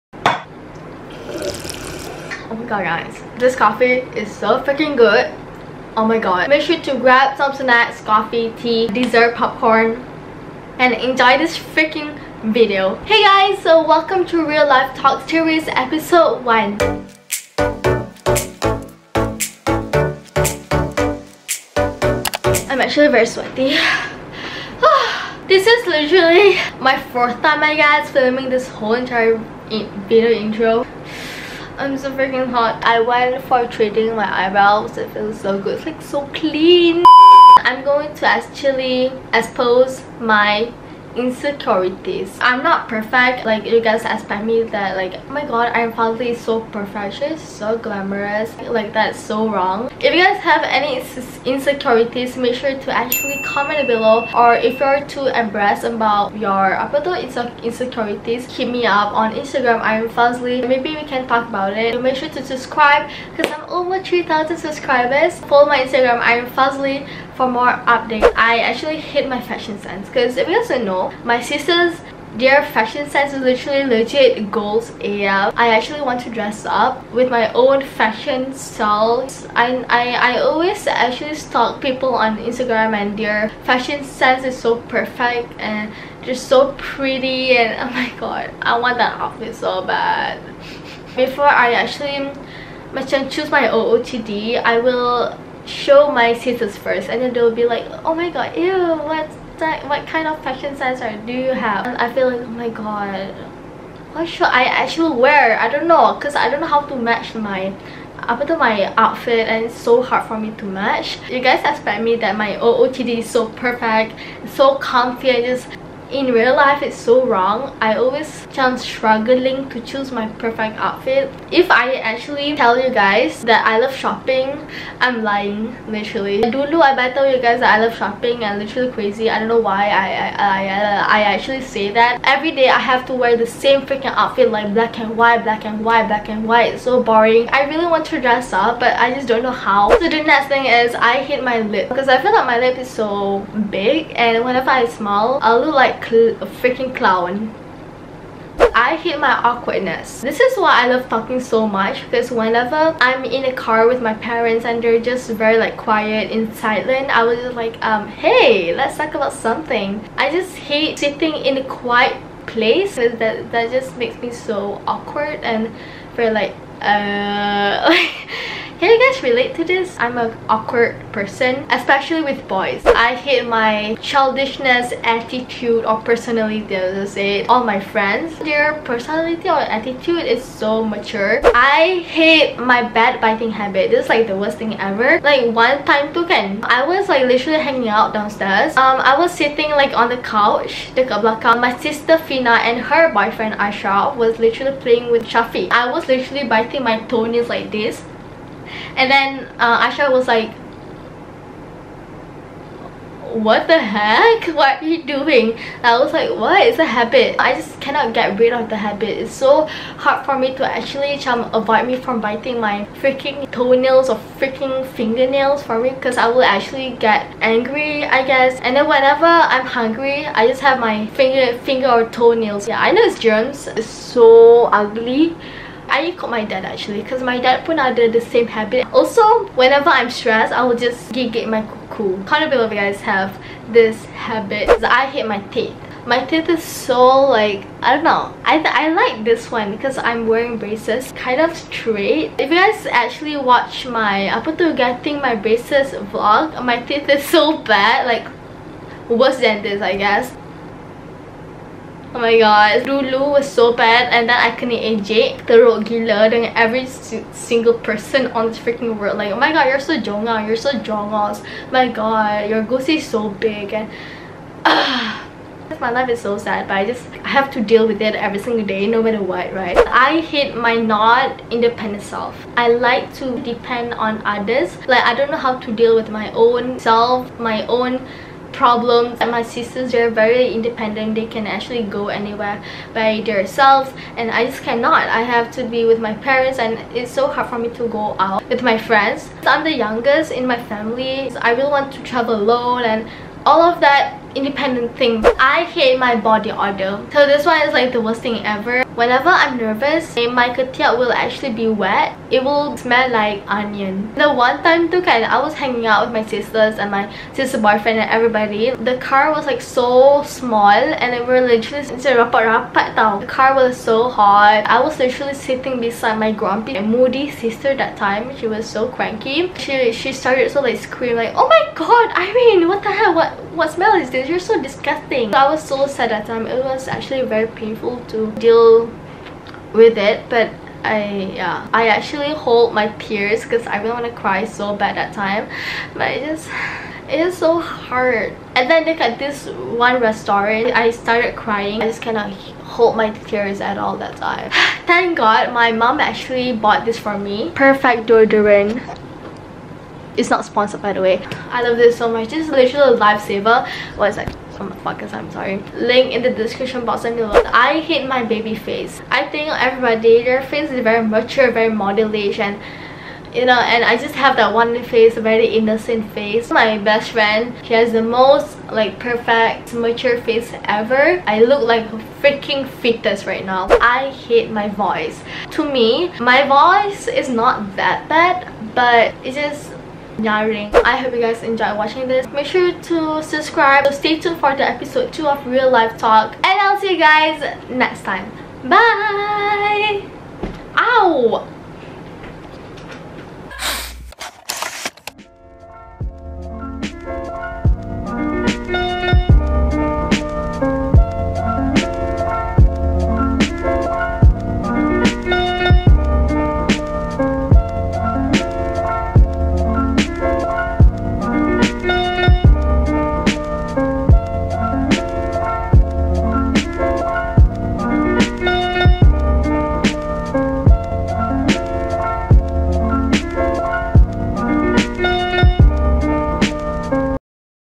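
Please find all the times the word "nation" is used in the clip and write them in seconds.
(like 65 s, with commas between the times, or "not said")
not said.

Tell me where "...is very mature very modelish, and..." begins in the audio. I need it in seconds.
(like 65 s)
360 s.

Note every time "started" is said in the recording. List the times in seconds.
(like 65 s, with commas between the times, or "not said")
320 s, 340 s.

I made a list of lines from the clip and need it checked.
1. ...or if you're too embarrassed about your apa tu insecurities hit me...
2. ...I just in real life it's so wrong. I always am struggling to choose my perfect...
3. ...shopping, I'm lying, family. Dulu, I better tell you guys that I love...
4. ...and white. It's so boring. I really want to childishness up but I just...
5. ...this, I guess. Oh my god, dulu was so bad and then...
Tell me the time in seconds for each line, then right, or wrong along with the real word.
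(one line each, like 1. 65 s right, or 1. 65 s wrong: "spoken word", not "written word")
1. 54 s right
2. 115 s right
3. 123 s wrong: "literally", not "family"
4. 136 s wrong: "dress", not "childishness"
5. 249 s right.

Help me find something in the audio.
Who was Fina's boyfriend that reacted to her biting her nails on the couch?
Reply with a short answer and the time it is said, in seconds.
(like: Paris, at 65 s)
Ashraf, at 193 s.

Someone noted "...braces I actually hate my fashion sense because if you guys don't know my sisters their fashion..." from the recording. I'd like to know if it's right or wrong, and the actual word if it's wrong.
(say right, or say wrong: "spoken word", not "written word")
wrong: "updates", not "braces".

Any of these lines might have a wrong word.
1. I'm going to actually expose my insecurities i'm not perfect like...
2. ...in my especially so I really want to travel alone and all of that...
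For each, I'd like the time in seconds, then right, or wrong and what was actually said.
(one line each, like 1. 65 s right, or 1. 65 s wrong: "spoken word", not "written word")
1. 37 s right
2. 290 s wrong: "family", not "especially".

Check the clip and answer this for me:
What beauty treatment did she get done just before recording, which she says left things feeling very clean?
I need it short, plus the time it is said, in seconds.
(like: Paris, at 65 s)
Eyebrows, at 34 s.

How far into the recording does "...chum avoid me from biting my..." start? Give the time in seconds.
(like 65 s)
211 s.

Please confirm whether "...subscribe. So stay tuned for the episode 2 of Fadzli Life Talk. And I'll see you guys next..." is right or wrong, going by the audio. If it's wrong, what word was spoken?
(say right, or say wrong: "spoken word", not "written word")
wrong: "Real", not "Fadzli".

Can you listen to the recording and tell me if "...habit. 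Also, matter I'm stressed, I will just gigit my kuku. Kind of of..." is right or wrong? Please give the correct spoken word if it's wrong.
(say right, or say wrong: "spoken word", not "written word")
wrong: "whenever", not "matter".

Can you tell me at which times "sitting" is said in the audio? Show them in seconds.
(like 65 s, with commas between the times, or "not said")
160 s, 189 s, 315 s.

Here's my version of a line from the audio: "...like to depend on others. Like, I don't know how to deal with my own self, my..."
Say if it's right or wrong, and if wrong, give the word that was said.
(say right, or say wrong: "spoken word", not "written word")
right.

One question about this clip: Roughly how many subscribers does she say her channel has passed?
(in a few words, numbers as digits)
3000.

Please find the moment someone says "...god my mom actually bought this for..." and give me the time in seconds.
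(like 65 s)
345 s.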